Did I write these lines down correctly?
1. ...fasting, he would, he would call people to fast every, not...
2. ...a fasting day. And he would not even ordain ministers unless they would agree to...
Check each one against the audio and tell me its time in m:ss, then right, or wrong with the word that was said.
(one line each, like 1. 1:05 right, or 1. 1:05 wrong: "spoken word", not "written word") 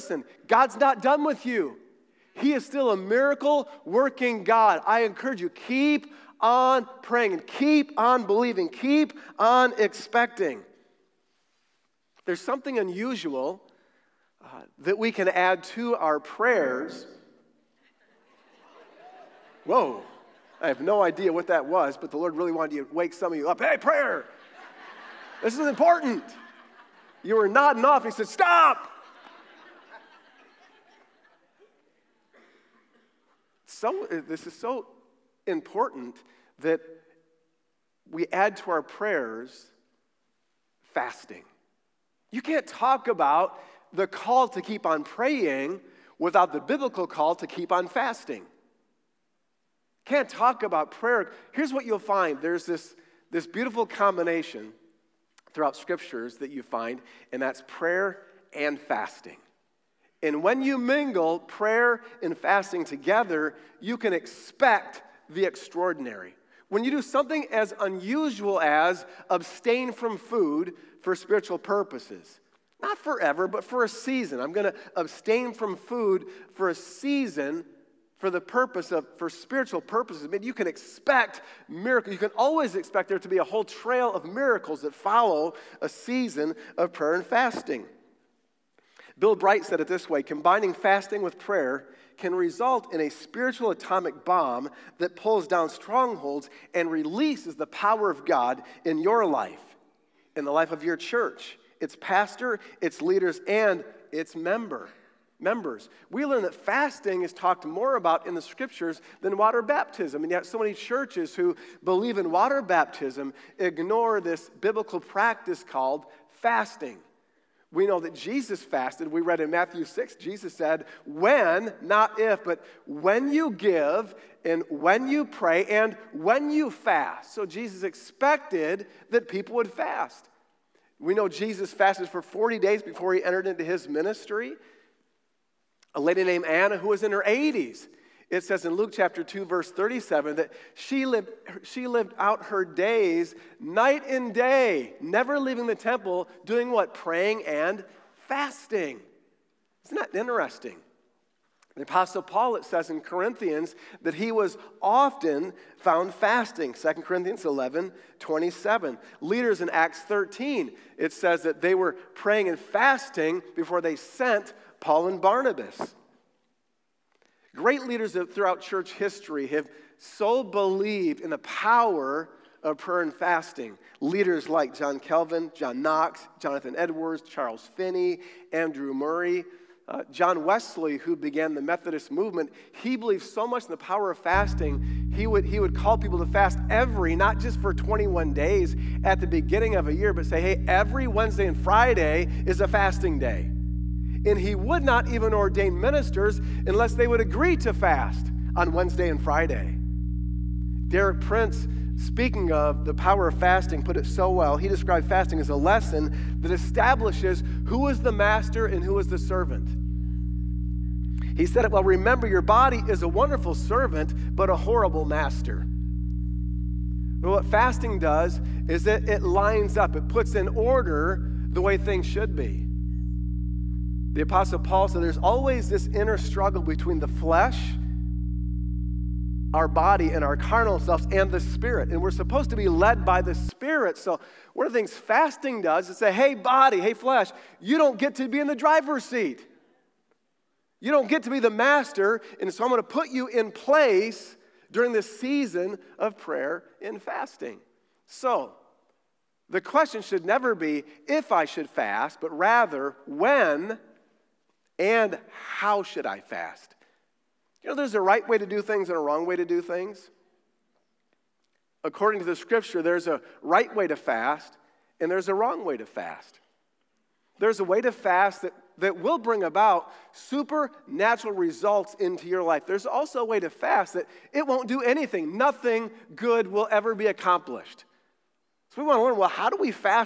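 1. 3:04 right
2. 3:12 right.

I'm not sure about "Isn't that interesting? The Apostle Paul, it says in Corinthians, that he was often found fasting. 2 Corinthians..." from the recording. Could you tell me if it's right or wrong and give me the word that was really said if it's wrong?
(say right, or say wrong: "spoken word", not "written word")
right.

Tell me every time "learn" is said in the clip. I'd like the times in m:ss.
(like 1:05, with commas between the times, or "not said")
1:46, 4:39.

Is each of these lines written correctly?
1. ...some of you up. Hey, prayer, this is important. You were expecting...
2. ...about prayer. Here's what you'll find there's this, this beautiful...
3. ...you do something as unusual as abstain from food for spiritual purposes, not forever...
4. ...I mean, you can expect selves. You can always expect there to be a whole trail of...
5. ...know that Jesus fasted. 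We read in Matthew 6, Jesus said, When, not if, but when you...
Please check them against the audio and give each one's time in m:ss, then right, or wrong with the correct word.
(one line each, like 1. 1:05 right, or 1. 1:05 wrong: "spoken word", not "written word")
1. 0:23 wrong: "nodding", not "expecting"
2. 0:50 right
3. 1:06 right
4. 1:20 wrong: "miracles", not "selves"
5. 1:57 right.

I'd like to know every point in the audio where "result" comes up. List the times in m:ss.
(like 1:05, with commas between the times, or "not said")
1:32, 4:31.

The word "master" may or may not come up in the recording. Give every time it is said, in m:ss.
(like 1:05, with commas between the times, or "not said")
3:28, 3:35, 4:01.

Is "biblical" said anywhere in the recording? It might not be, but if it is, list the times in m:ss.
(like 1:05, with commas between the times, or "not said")
0:46, 1:54.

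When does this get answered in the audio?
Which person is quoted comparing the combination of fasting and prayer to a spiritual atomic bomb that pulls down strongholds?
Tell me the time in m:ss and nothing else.
1:29.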